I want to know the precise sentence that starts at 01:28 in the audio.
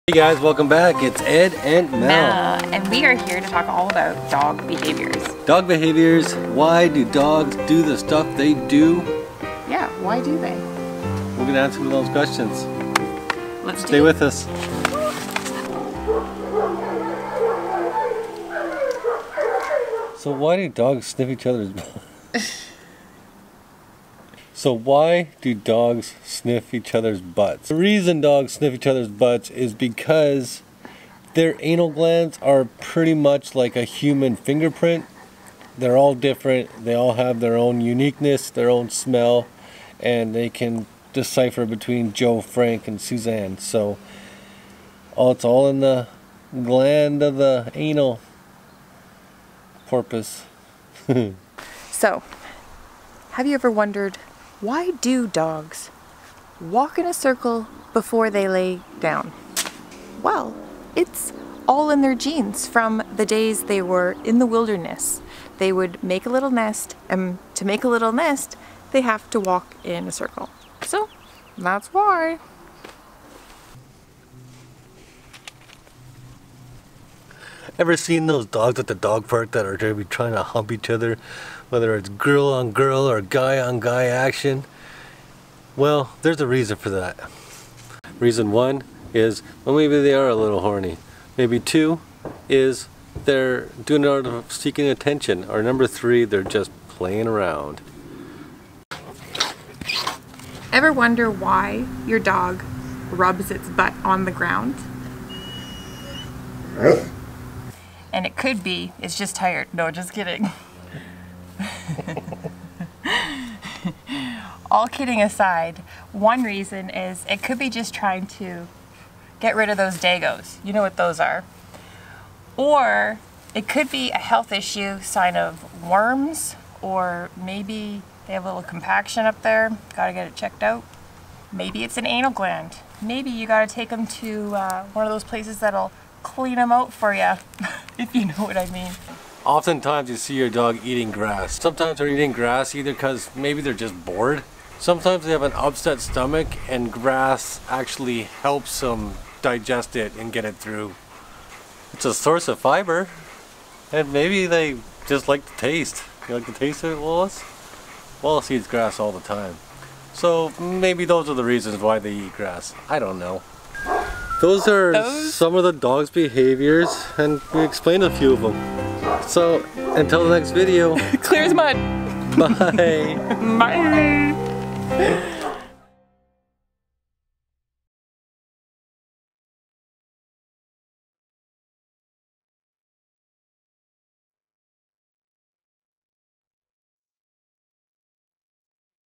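Reason one is, well, maybe they are a little horny.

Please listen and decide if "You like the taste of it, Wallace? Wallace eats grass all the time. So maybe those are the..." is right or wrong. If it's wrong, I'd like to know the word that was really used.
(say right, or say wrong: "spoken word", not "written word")
right.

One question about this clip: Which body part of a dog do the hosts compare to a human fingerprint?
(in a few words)
anal glands.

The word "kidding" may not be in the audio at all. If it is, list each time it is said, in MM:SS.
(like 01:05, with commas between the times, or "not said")
01:50, 01:54.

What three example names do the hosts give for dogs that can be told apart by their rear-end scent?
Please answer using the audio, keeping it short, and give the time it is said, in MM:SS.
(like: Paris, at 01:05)
Joe, Frank, and Suzanne, at 00:42.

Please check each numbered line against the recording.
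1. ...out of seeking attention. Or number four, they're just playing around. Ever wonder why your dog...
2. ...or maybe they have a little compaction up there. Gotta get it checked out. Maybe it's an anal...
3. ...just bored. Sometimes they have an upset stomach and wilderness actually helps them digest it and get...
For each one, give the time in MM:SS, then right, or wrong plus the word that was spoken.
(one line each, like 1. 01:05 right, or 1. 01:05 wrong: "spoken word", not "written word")
1. 01:34 wrong: "three", not "four"
2. 02:06 right
3. 02:23 wrong: "grass", not "wilderness".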